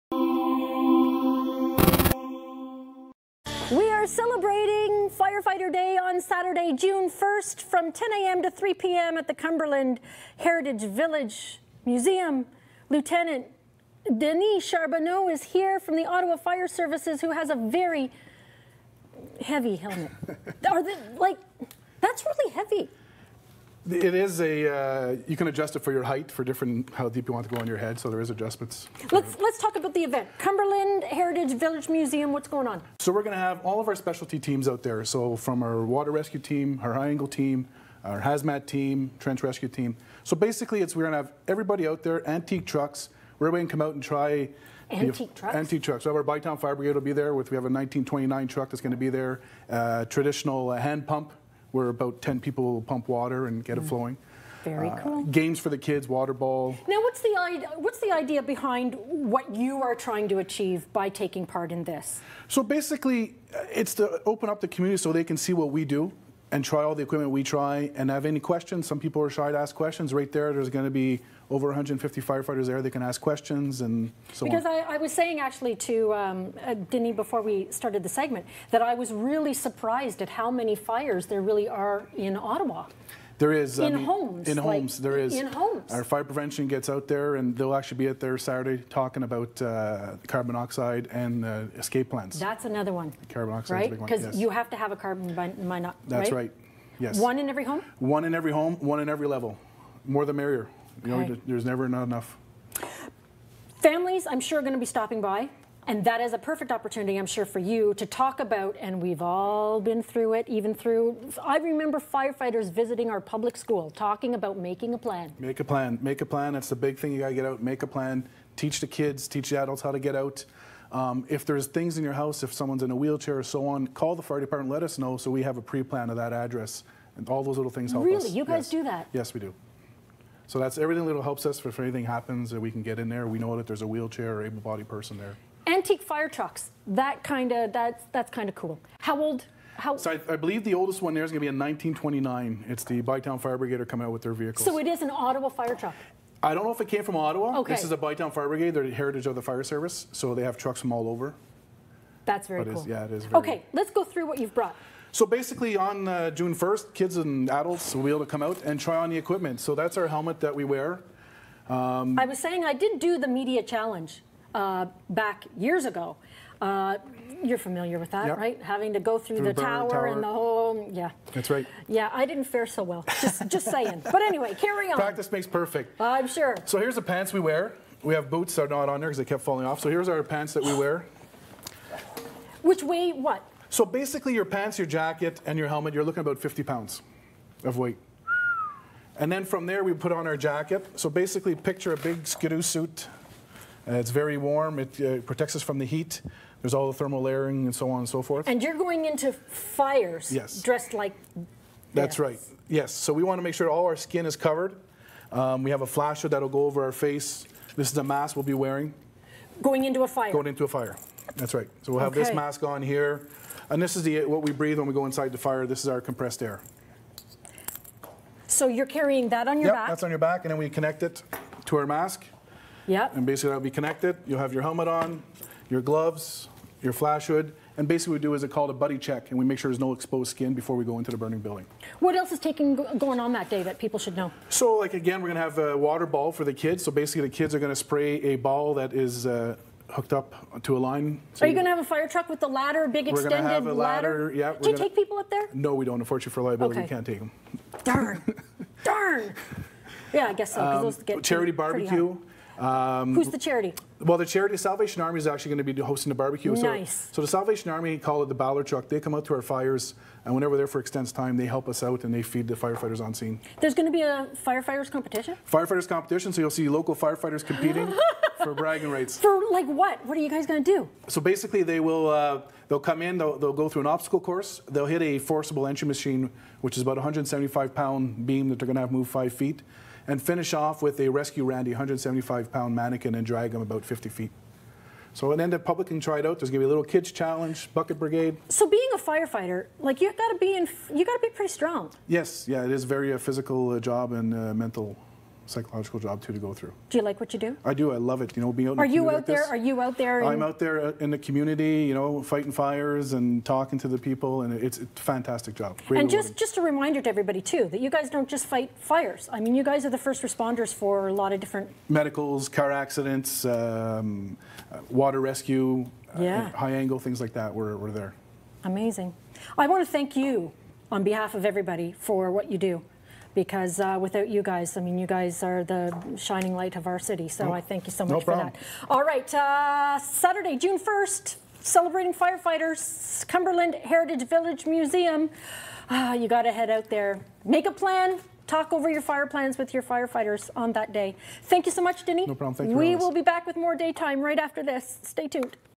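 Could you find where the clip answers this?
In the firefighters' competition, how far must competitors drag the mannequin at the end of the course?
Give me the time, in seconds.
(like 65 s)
283 s.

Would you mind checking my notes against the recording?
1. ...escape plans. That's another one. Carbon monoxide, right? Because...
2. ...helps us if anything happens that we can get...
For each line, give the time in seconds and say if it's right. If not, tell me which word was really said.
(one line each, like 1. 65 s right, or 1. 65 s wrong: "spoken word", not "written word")
1. 91 s right
2. 131 s right.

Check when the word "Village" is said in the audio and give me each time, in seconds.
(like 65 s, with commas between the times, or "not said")
10 s, 31 s, 334 s.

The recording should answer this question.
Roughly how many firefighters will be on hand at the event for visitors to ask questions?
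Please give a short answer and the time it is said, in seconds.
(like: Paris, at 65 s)
over 150, at 71 s.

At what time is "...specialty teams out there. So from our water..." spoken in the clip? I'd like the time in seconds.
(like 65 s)
33 s.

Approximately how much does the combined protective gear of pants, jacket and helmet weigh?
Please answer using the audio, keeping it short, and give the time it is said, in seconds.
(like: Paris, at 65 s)
50 pounds, at 186 s.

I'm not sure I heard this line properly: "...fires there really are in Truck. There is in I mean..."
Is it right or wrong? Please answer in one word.
wrong.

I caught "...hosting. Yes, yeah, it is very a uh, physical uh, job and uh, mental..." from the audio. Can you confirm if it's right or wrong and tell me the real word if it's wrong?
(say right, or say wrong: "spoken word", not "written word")
wrong: "strong", not "hosting".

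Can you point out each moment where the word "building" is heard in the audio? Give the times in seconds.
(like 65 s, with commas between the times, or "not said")
231 s.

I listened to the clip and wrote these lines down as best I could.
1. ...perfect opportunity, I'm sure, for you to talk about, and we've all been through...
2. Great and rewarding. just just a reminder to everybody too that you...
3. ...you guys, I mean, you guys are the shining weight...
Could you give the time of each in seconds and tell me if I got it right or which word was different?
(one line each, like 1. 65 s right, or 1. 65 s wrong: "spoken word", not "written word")
1. 106 s right
2. 305 s right
3. 324 s wrong: "light", not "weight".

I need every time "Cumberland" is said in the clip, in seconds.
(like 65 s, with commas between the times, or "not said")
9 s, 30 s, 333 s.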